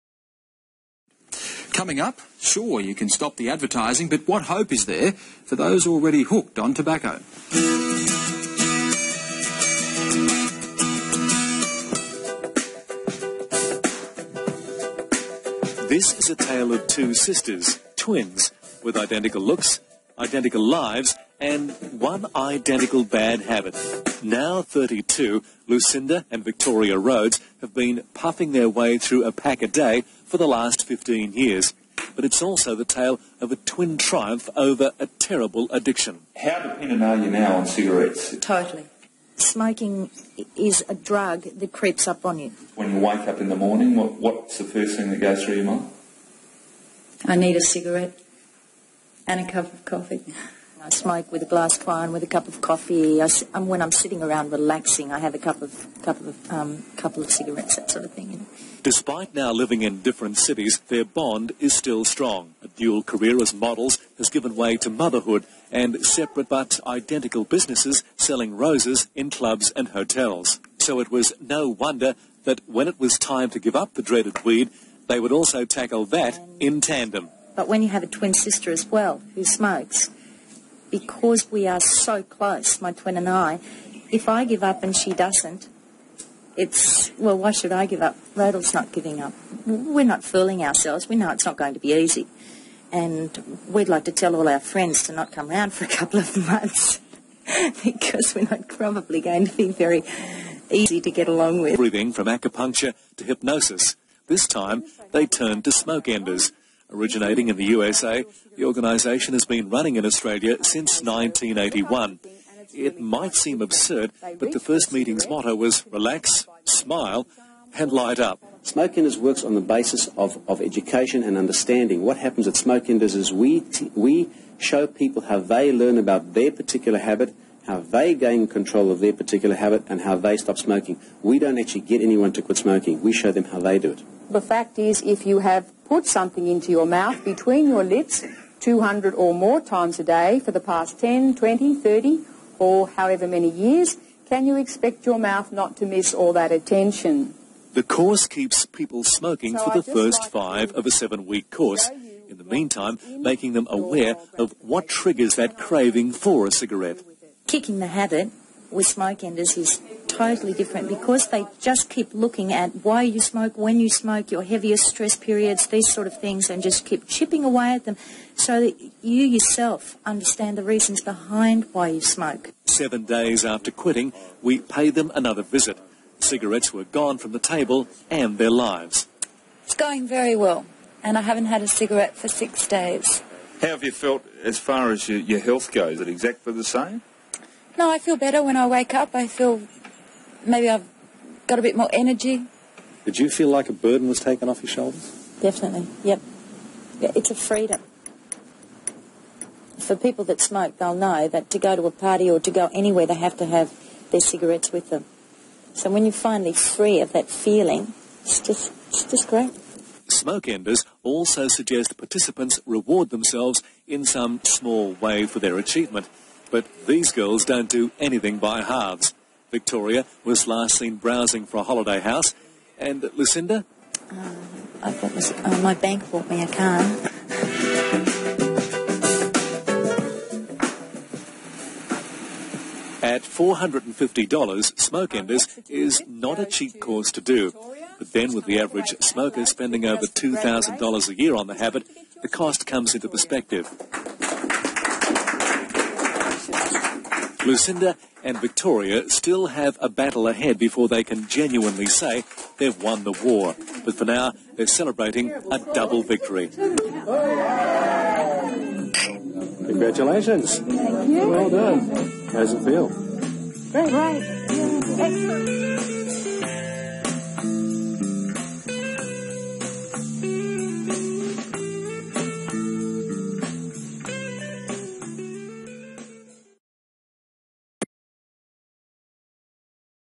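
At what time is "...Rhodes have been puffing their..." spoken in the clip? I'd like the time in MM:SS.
00:26.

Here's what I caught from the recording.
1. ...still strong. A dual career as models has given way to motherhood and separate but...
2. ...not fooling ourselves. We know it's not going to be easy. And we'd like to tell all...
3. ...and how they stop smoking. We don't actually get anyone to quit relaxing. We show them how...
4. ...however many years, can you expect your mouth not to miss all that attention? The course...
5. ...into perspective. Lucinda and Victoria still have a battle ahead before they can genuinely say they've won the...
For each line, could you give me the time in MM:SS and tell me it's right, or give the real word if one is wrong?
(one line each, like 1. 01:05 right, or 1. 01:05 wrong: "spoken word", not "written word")
1. 01:01 right
2. 01:30 right
3. 02:09 wrong: "smoking", not "relaxing"
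4. 02:22 right
5. 04:02 right.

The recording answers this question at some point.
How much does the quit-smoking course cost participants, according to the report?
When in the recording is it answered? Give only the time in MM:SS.
03:53.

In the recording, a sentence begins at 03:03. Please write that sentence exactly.
How have you felt as far as your, your health goes?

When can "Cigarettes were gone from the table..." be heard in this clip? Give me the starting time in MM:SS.
02:56.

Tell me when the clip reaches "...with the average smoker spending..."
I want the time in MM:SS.
03:58.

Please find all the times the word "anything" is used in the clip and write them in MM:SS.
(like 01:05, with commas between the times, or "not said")
03:37.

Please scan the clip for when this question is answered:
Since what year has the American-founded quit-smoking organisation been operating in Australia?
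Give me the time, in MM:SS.
01:51.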